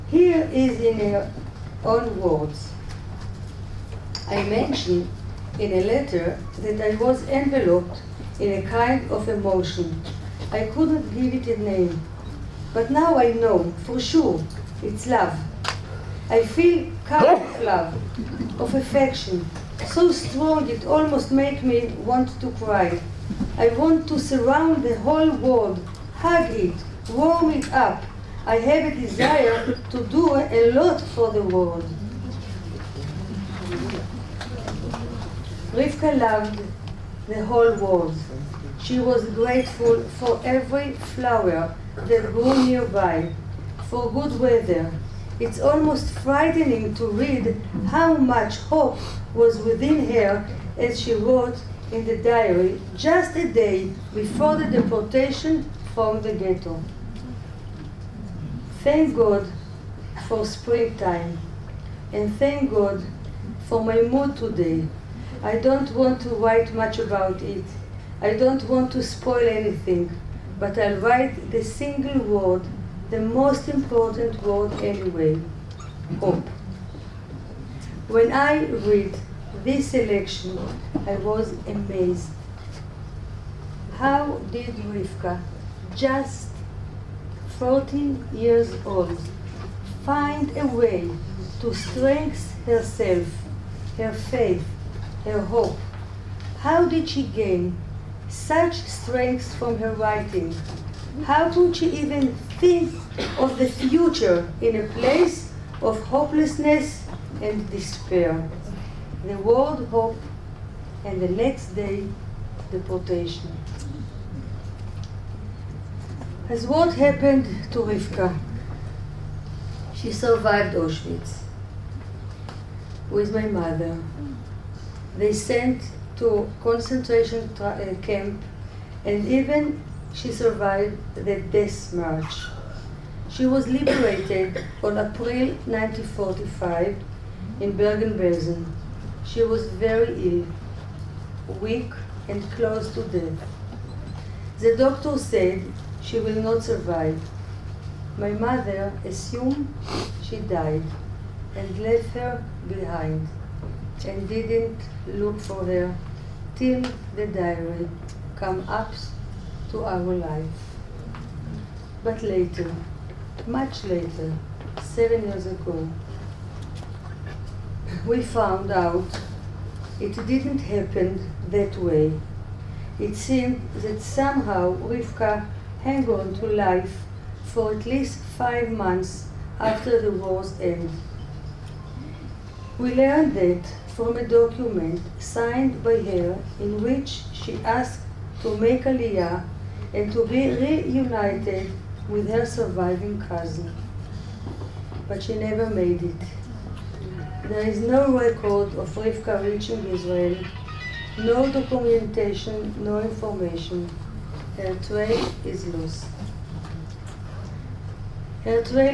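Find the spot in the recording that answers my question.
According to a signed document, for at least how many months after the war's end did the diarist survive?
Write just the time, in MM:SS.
02:58.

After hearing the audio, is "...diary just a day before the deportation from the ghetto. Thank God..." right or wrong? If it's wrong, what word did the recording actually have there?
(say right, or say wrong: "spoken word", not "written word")
right.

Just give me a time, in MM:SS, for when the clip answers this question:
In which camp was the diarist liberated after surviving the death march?
02:17.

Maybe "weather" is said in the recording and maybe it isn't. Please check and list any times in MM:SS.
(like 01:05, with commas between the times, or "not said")
00:44.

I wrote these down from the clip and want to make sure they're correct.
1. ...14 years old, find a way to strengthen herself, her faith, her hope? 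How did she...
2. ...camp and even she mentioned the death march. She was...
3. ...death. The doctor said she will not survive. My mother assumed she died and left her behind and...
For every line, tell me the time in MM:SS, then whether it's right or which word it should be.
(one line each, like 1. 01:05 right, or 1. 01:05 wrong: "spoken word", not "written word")
1. 01:27 right
2. 02:08 wrong: "survived", not "mentioned"
3. 02:23 right.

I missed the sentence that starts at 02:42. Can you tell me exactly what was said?
But later, much later, seven years ago, we found out it didn't happen that way.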